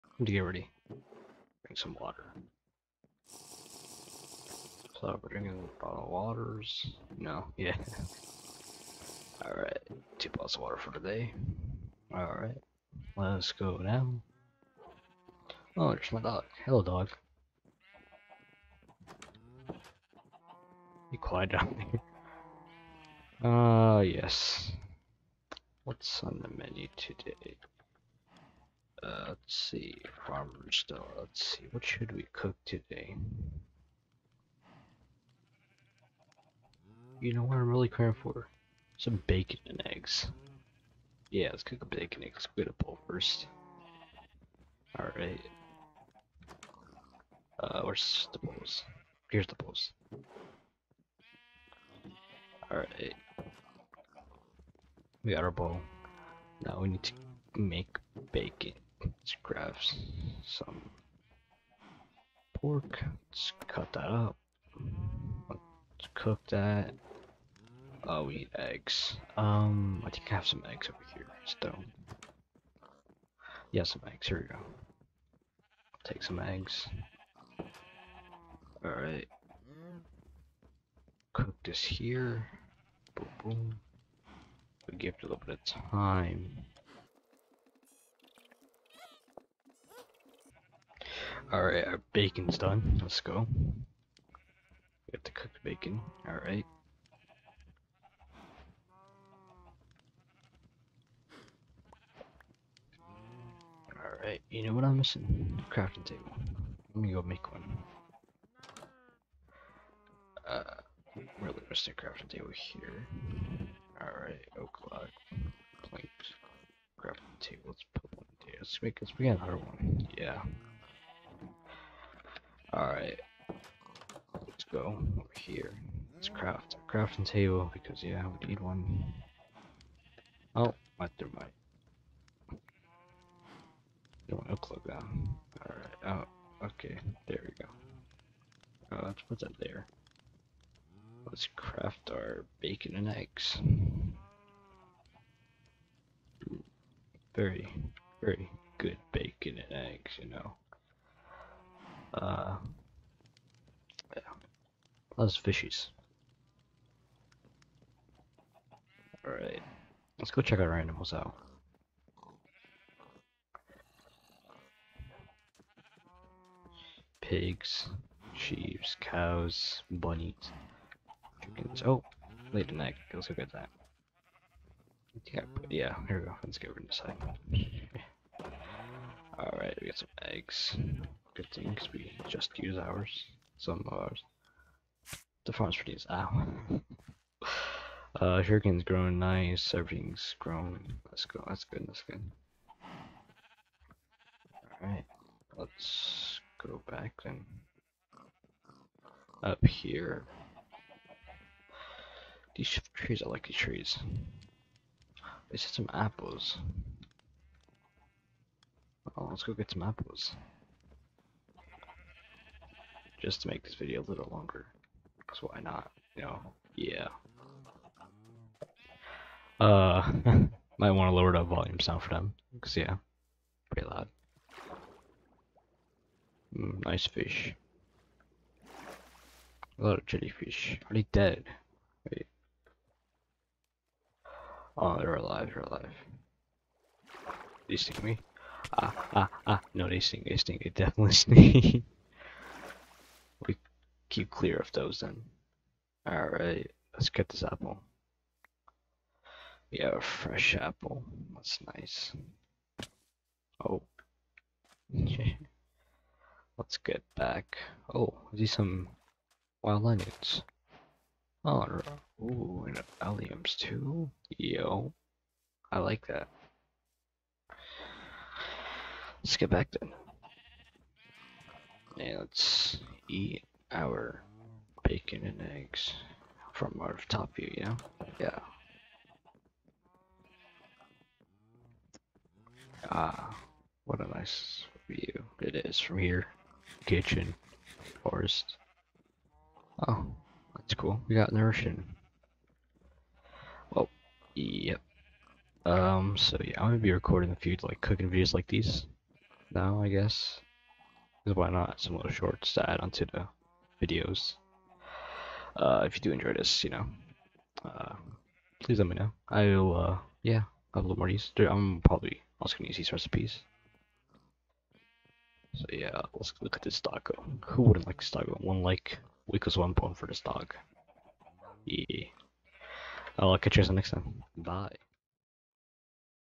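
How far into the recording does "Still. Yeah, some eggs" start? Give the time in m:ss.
1:11.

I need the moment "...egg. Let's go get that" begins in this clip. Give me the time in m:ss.
2:52.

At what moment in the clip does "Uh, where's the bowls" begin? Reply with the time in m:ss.
0:47.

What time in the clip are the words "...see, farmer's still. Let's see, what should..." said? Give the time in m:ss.
0:29.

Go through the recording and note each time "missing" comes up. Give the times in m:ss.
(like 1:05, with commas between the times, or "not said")
1:44, 1:51.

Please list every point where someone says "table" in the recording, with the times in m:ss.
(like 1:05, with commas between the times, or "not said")
1:46, 1:52, 1:57, 2:07.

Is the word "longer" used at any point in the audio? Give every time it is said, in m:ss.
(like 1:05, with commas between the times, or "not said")
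3:34.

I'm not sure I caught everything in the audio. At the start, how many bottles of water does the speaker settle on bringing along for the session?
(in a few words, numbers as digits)
2.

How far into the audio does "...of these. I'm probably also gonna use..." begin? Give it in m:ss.
5:11.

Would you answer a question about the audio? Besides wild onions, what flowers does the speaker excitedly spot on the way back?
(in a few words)
Alliums.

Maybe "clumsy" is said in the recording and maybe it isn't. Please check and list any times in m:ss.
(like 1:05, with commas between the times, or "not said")
not said.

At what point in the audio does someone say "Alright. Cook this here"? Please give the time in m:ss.
1:18.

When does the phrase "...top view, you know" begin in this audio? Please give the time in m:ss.
4:37.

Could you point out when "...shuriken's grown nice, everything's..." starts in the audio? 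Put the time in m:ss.
3:08.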